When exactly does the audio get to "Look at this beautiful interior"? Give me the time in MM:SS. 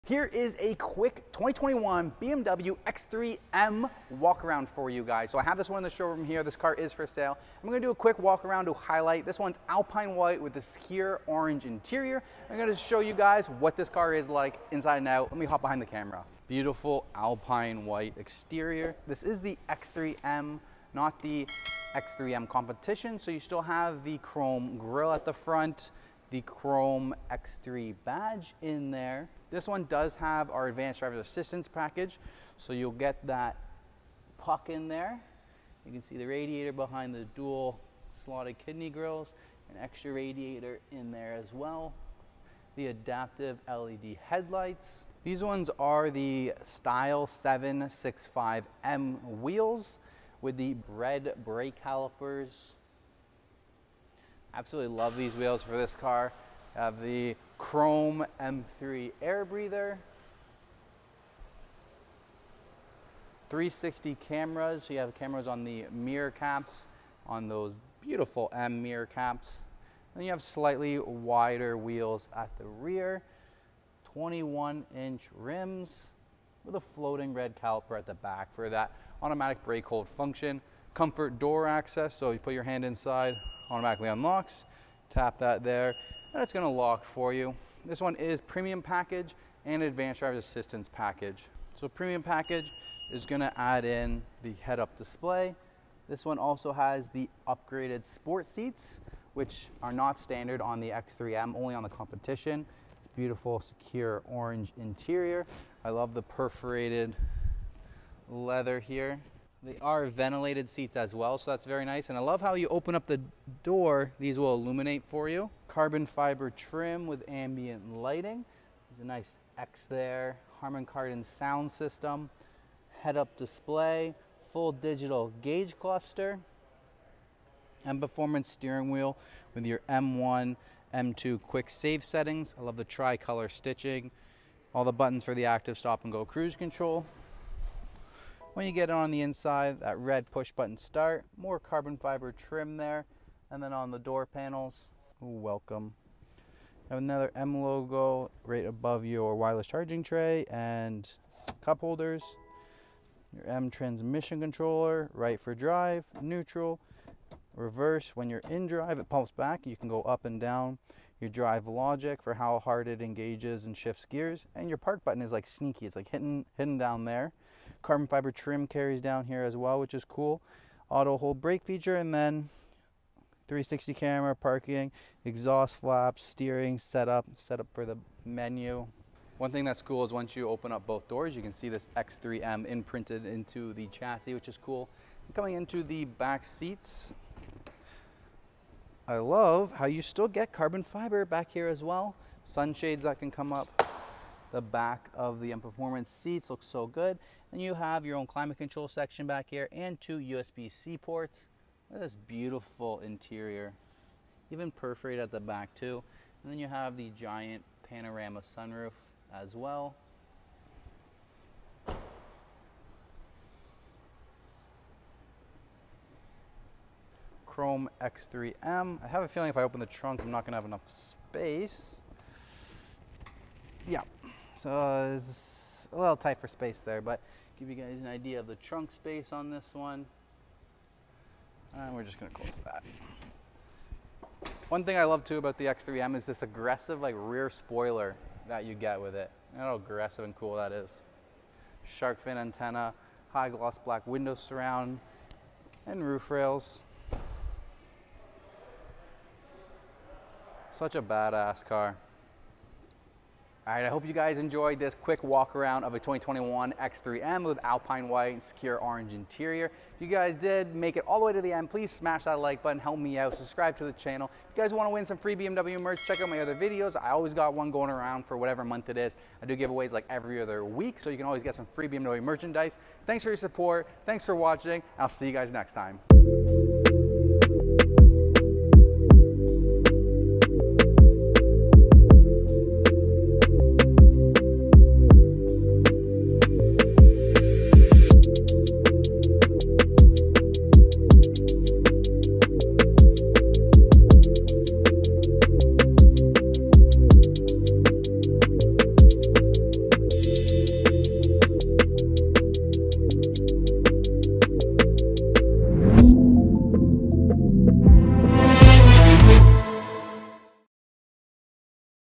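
03:21.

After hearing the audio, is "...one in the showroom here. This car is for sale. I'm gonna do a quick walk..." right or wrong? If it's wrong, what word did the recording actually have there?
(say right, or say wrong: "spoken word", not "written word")
right.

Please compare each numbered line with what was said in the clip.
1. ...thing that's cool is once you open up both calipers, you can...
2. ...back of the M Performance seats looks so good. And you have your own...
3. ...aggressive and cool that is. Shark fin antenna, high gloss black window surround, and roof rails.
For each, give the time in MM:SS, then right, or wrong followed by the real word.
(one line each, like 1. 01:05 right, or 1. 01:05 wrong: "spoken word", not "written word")
1. 02:59 wrong: "doors", not "calipers"
2. 03:14 right
3. 03:59 right.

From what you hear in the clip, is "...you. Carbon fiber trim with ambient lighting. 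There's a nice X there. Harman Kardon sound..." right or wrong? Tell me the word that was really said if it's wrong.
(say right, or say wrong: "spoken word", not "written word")
right.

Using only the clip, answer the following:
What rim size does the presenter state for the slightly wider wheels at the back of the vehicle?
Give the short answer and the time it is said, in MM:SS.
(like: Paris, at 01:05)
21 inch, at 01:14.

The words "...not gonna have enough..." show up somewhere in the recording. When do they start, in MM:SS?
03:40.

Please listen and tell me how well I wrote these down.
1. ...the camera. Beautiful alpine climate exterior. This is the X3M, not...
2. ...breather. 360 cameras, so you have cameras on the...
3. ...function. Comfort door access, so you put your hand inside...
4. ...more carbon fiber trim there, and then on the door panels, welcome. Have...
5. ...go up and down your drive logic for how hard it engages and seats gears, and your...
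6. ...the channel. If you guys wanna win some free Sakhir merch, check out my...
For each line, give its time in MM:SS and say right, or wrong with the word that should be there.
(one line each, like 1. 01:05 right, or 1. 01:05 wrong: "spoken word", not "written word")
1. 00:15 wrong: "white", not "climate"
2. 00:59 right
3. 01:20 right
4. 02:21 right
5. 02:39 wrong: "shifts", not "seats"
6. 04:23 wrong: "BMW", not "Sakhir".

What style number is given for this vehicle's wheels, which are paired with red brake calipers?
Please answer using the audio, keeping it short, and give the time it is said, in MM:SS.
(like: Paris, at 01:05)
765M, at 00:46.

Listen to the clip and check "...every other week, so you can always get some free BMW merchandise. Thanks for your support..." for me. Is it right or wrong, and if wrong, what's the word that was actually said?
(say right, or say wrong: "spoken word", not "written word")
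right.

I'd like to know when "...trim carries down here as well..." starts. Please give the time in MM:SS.
02:48.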